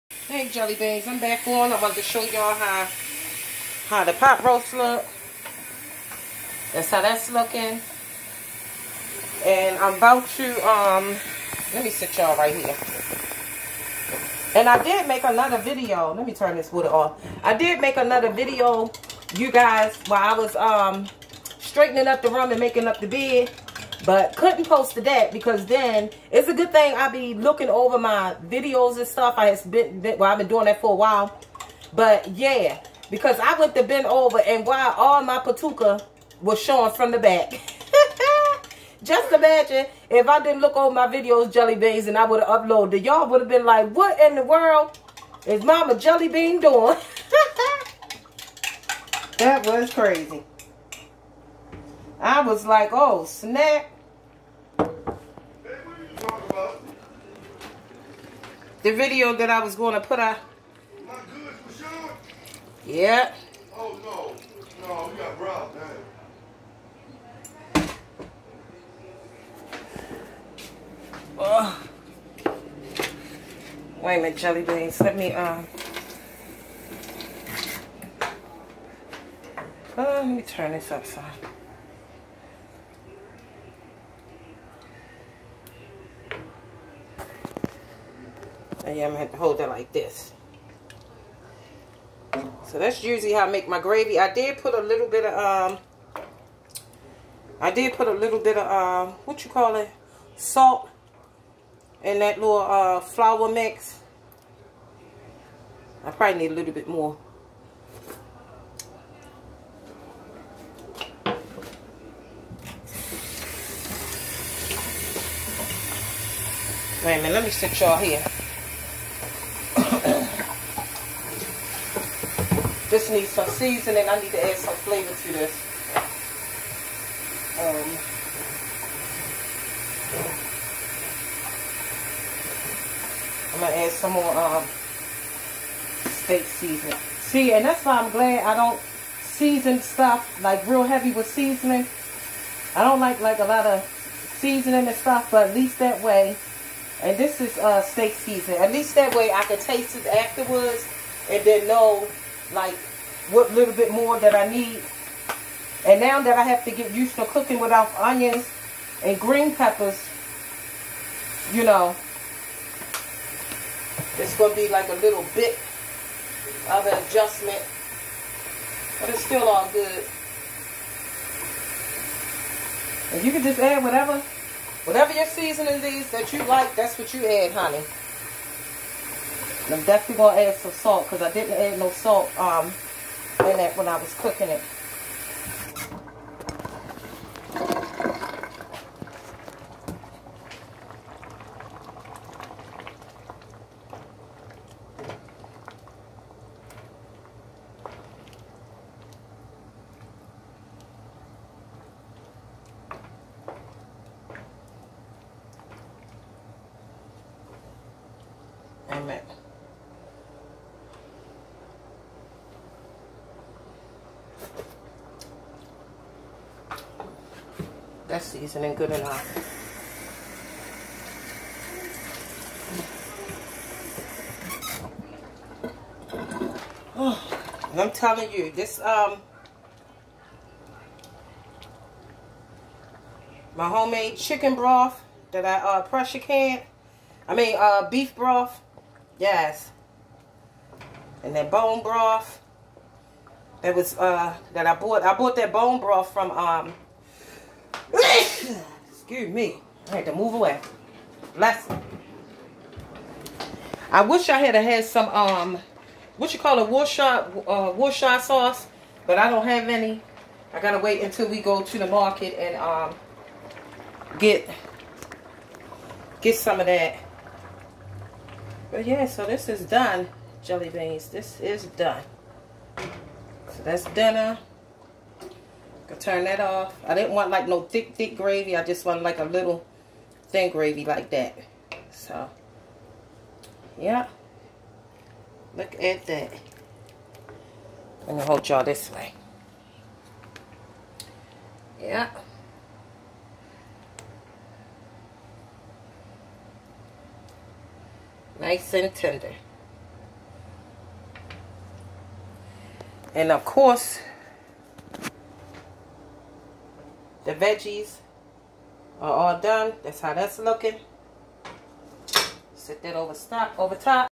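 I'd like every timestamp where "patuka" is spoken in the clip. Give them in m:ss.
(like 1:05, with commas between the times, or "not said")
0:35.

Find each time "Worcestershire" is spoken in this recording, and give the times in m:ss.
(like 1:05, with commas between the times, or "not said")
4:16.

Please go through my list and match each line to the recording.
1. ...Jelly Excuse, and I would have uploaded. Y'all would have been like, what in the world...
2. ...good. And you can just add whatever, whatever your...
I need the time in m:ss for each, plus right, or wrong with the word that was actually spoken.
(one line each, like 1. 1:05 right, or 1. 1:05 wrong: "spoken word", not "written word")
1. 0:41 wrong: "Beans", not "Excuse"
2. 2:49 right.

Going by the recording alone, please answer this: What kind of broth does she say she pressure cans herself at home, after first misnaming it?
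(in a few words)
beef broth.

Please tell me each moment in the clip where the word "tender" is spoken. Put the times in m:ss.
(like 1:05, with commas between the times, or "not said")
4:58.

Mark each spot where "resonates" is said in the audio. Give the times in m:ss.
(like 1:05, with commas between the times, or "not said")
not said.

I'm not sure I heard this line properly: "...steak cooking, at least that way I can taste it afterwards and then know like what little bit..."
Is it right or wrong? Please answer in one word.
wrong.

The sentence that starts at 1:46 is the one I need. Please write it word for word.
I probably need a little bit more.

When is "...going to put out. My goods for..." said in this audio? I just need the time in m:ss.
0:59.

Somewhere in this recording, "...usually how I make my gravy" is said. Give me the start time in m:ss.
1:33.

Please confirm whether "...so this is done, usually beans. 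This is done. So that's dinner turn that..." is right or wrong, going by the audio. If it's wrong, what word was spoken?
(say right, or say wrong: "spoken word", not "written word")
wrong: "jelly", not "usually".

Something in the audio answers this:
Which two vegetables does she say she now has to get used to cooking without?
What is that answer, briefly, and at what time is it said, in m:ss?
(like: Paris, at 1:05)
onions and green peppers, at 2:37.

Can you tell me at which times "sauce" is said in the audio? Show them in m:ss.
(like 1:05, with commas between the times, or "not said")
4:18.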